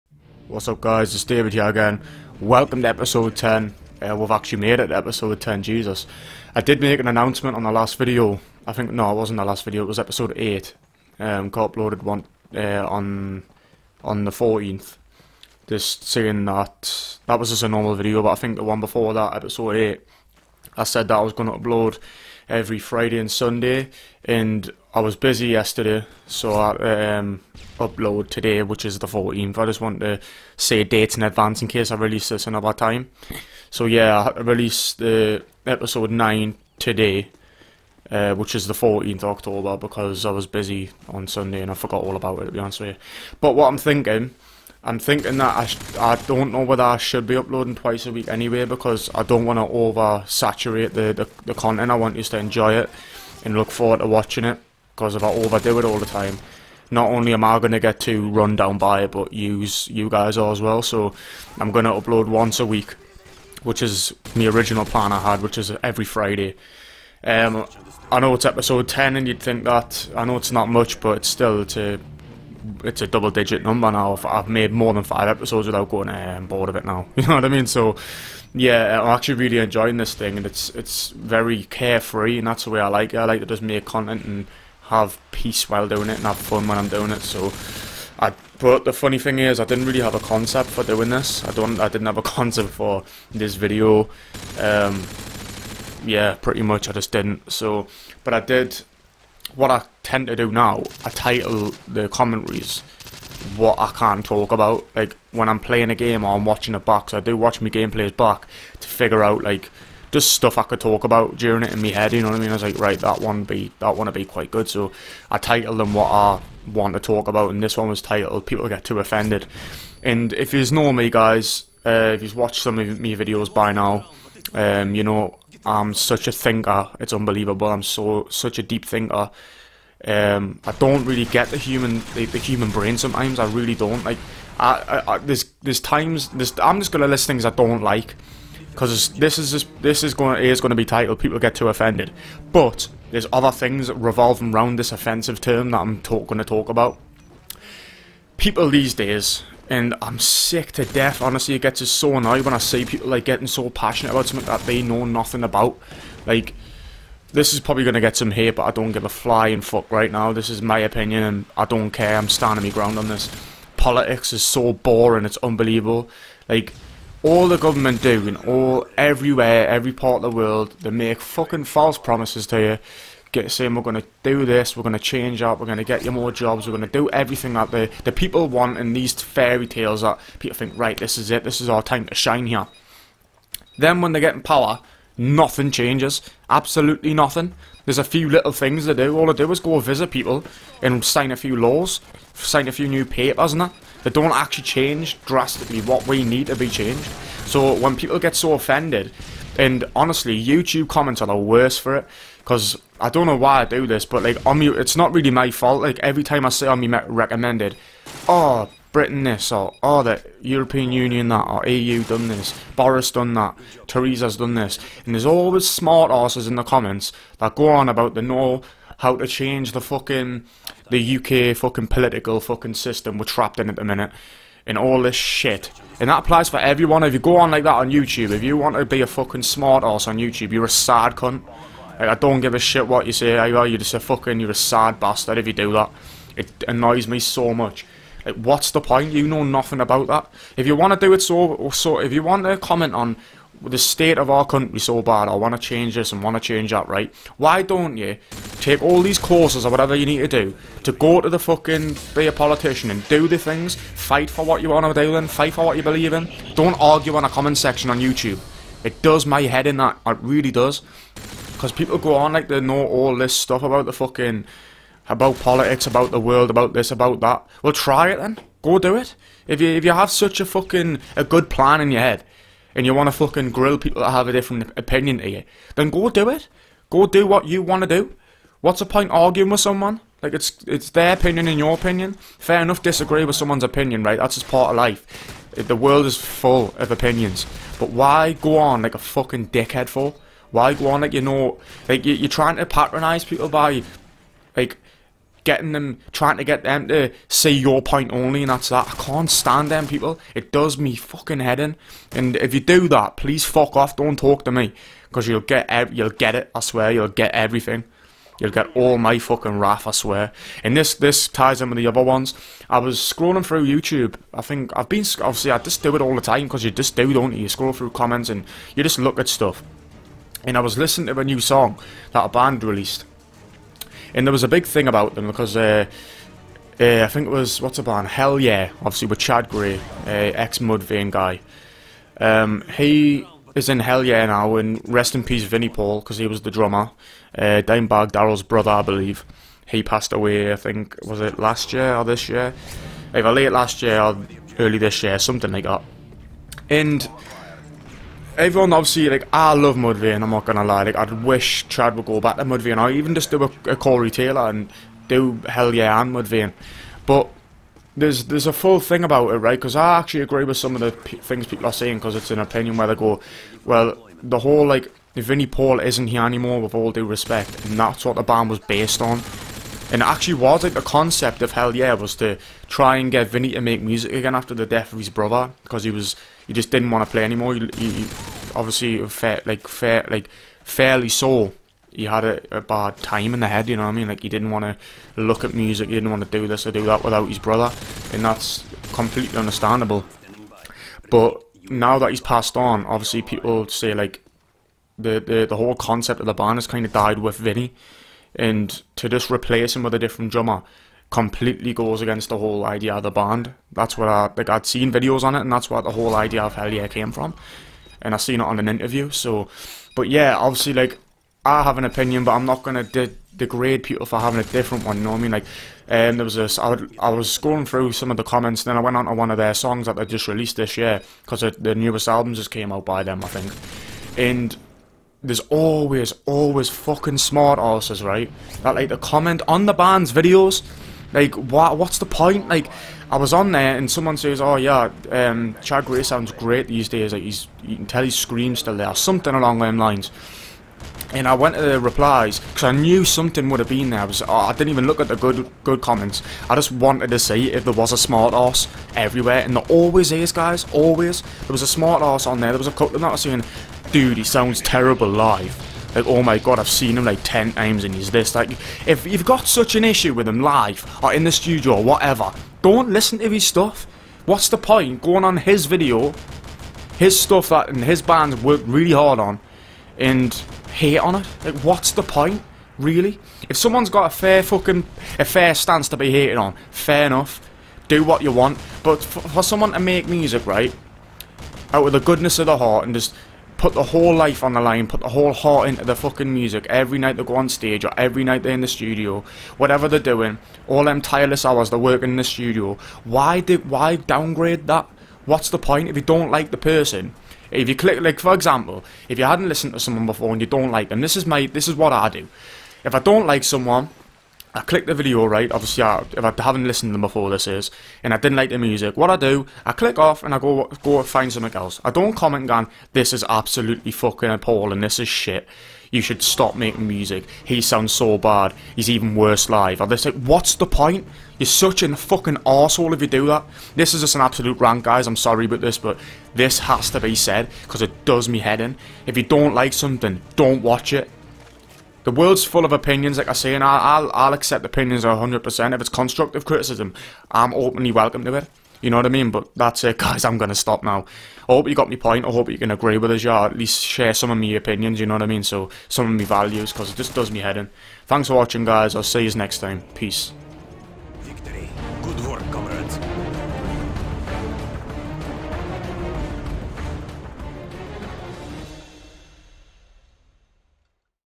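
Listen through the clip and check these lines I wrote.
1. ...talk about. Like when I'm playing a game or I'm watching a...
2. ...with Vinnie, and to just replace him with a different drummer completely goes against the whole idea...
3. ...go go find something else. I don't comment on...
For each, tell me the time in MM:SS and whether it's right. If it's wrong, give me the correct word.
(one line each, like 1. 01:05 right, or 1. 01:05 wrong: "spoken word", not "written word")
1. 01:44 right
2. 06:37 right
3. 08:30 right.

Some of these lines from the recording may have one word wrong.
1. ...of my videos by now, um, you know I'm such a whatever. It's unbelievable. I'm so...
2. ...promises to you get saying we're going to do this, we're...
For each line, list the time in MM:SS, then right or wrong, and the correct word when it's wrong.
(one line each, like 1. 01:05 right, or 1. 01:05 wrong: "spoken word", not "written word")
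1. 02:02 wrong: "thinker", not "whatever"
2. 02:51 right.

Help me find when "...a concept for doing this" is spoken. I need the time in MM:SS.
01:30.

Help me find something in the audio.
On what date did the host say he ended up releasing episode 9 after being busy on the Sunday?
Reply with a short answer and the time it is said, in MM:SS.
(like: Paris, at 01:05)
14th October, at 00:38.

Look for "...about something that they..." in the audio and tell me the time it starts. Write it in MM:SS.
02:34.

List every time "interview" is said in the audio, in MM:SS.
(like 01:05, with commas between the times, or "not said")
06:48.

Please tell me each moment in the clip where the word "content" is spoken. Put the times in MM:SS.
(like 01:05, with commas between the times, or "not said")
00:51, 01:23.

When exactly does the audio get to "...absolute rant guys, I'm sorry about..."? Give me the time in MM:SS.
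08:44.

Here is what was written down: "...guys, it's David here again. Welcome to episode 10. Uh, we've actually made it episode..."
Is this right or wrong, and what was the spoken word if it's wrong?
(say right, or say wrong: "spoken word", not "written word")
right.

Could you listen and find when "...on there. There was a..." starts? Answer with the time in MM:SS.
07:32.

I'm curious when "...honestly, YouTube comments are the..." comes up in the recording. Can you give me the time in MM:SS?
03:19.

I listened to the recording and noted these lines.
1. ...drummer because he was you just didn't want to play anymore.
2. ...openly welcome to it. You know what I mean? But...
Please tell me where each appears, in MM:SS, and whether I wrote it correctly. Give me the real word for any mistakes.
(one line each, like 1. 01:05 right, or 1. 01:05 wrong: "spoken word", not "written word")
1. 06:15 wrong: "brother", not "drummer"
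2. 08:57 right.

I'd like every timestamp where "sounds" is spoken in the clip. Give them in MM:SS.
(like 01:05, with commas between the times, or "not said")
07:16, 07:34, 08:37.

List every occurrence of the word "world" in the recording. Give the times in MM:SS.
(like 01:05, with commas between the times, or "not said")
02:50, 04:26, 04:45, 08:52.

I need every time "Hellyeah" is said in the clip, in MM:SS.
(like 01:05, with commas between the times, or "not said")
05:28, 05:33, 05:55, 06:11, 06:46.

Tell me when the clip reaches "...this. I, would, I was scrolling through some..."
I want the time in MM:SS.
06:56.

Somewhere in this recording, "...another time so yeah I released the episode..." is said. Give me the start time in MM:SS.
00:32.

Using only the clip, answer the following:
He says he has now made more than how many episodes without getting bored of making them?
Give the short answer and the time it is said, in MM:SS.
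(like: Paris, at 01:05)
5, at 01:15.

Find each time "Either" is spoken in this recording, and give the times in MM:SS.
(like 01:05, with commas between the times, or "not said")
03:53, 05:43.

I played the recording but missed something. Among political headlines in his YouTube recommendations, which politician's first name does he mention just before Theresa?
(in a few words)
Boris.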